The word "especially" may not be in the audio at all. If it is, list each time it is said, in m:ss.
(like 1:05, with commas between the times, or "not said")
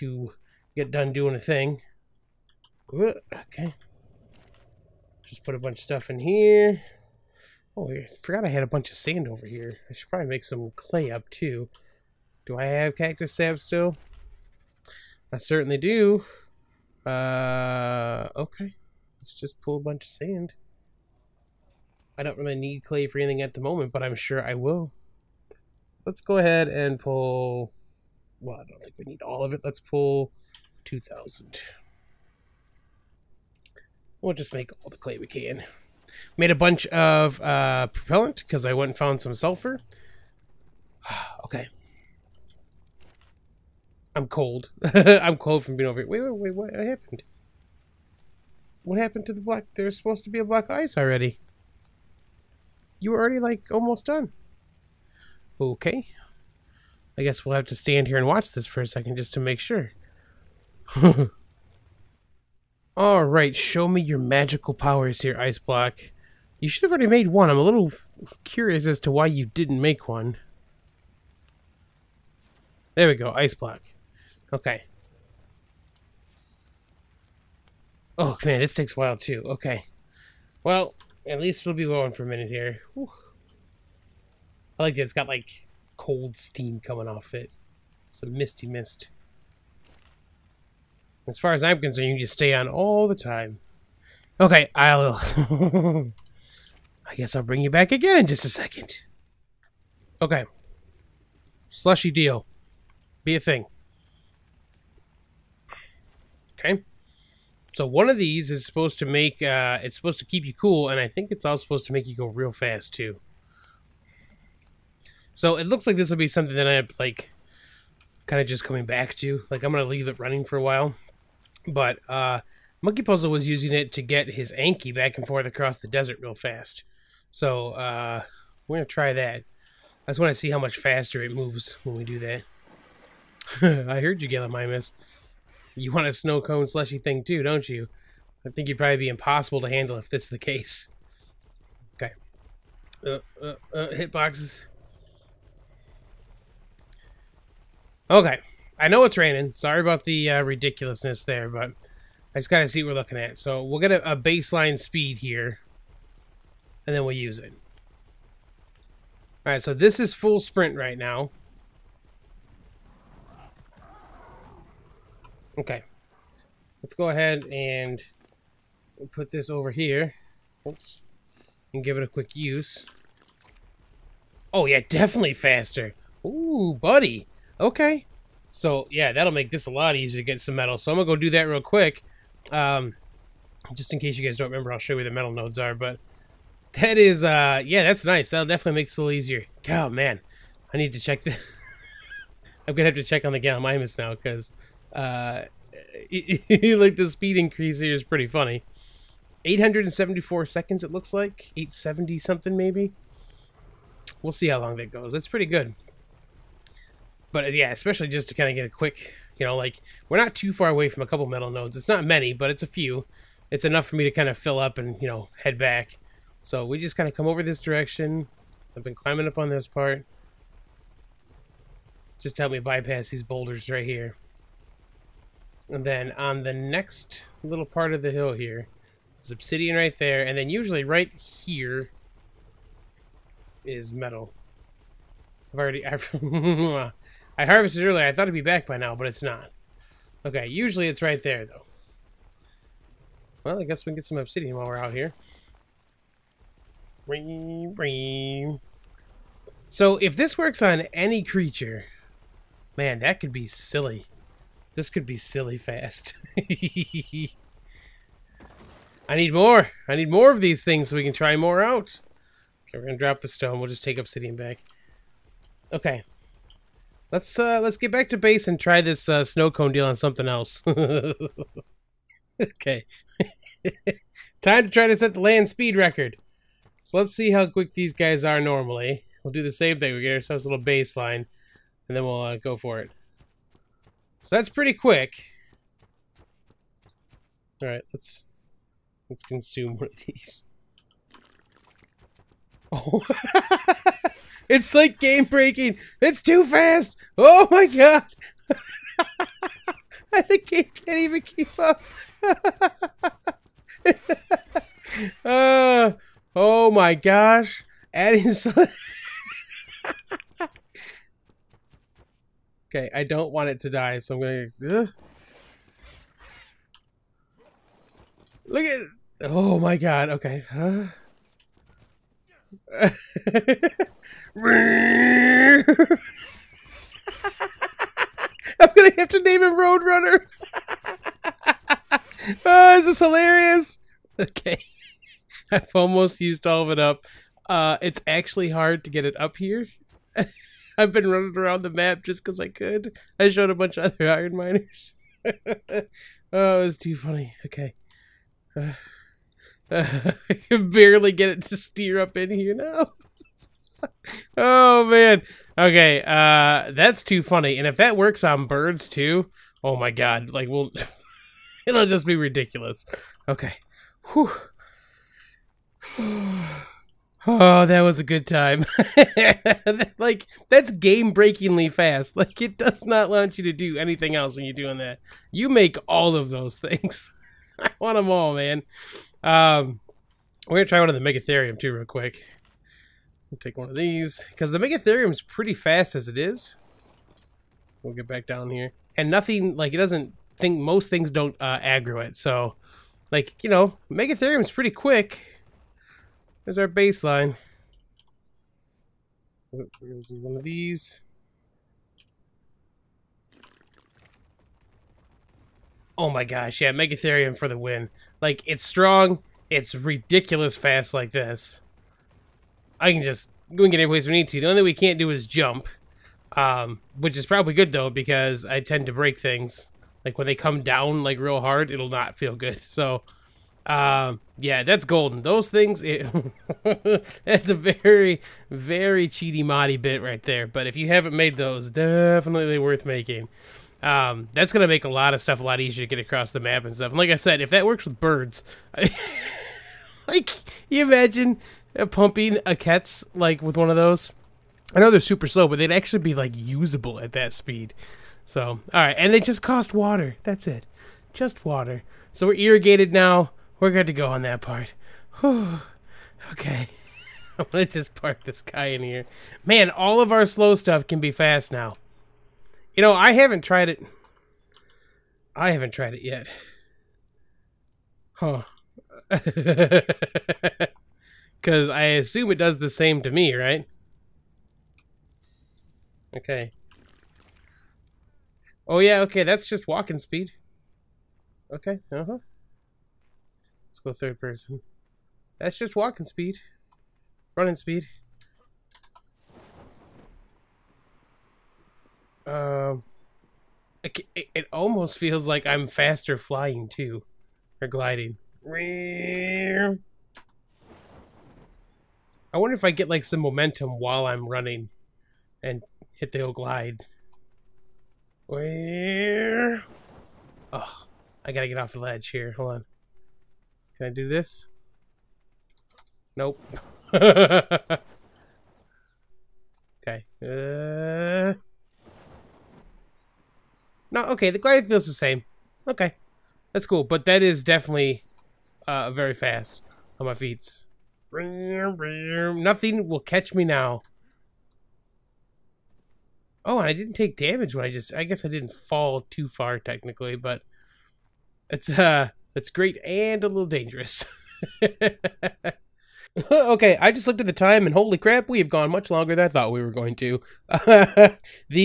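3:27.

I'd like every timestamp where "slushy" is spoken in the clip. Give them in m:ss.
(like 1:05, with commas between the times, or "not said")
1:41, 2:16.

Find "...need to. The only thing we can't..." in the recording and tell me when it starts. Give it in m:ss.
6:54.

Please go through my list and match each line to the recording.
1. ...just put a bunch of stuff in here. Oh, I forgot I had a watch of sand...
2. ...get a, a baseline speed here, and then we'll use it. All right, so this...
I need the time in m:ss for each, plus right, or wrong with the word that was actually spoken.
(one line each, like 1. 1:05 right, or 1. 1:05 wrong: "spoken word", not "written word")
1. 0:05 wrong: "bunch", not "watch"
2. 2:33 right.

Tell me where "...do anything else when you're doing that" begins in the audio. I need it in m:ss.
6:13.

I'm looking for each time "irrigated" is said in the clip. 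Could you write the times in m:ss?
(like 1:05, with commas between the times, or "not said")
7:32.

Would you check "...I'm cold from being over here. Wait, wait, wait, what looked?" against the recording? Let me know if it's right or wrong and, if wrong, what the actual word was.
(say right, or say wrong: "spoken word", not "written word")
wrong: "happened", not "looked".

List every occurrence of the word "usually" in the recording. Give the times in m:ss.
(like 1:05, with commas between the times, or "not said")
3:50, 4:00.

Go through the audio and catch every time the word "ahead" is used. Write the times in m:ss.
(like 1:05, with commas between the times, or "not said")
0:26, 2:47.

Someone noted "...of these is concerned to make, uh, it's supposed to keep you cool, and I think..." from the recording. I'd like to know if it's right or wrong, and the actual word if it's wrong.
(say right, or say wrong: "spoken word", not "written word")
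wrong: "supposed", not "concerned".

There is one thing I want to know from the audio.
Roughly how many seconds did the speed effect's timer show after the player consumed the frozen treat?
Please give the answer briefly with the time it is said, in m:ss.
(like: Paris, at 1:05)
874, at 3:19.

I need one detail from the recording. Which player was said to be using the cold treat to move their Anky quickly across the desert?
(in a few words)
Monkey Puzzle.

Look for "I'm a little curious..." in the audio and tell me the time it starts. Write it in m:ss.
1:07.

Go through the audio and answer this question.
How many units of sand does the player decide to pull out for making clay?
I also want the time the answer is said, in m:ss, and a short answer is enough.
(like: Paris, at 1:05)
2,000, at 0:30.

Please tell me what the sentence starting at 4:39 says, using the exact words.
We get ourselves a little baseline, and then we'll uh, go for it.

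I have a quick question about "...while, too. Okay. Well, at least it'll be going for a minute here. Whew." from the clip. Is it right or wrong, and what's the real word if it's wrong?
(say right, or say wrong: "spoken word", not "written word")
right.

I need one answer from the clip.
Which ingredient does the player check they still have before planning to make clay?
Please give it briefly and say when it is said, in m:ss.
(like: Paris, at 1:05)
cactus sap, at 0:12.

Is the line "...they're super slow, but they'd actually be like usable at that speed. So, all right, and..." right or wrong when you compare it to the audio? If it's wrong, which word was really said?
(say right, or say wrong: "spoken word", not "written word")
right.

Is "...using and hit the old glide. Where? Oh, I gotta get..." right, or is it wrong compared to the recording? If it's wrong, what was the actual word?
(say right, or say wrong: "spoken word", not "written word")
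wrong: "running", not "using".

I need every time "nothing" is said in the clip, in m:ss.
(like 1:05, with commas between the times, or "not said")
6:29, 8:51.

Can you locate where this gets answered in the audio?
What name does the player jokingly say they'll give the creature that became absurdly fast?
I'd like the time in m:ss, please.
5:29.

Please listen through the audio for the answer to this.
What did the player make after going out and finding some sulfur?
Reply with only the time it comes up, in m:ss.
0:37.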